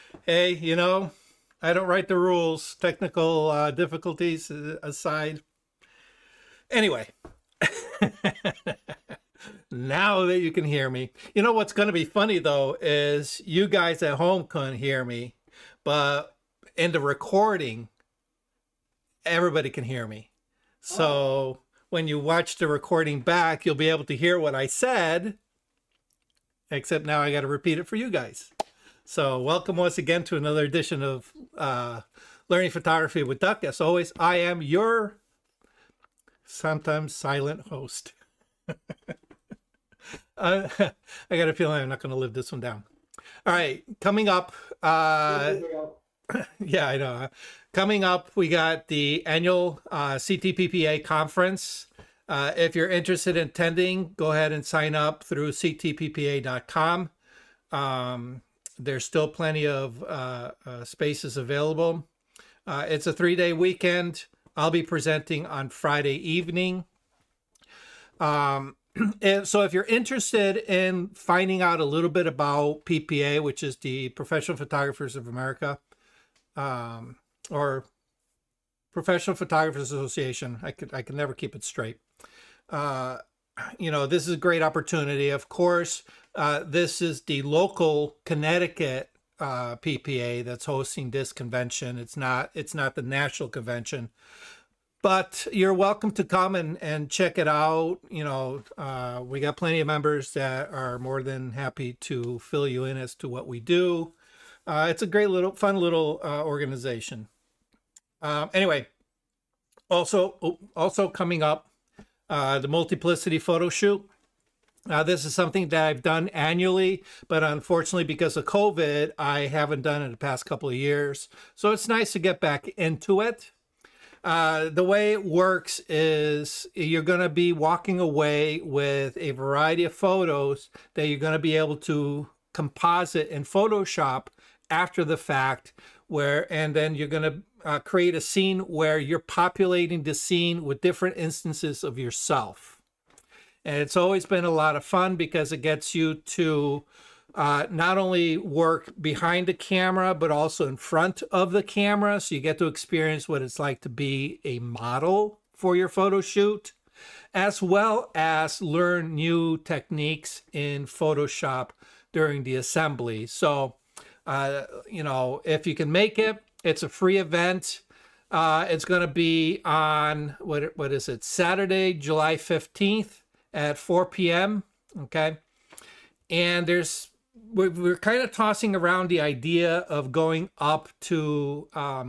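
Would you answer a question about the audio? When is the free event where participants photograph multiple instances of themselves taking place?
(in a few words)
Saturday, July 15.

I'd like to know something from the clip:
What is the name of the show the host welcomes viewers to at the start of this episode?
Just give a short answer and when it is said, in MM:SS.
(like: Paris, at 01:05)
Learning Photography with Duck, at 00:32.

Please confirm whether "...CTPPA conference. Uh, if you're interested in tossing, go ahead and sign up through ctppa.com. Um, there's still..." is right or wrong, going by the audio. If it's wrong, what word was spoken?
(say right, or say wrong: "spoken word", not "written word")
wrong: "attending", not "tossing".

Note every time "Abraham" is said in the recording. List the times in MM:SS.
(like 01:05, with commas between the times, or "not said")
not said.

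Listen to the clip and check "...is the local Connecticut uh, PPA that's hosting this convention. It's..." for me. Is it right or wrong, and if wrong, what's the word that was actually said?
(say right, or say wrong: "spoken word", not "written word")
right.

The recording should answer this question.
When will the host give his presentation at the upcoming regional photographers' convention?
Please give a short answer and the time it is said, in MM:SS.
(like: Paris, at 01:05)
Friday evening, at 01:05.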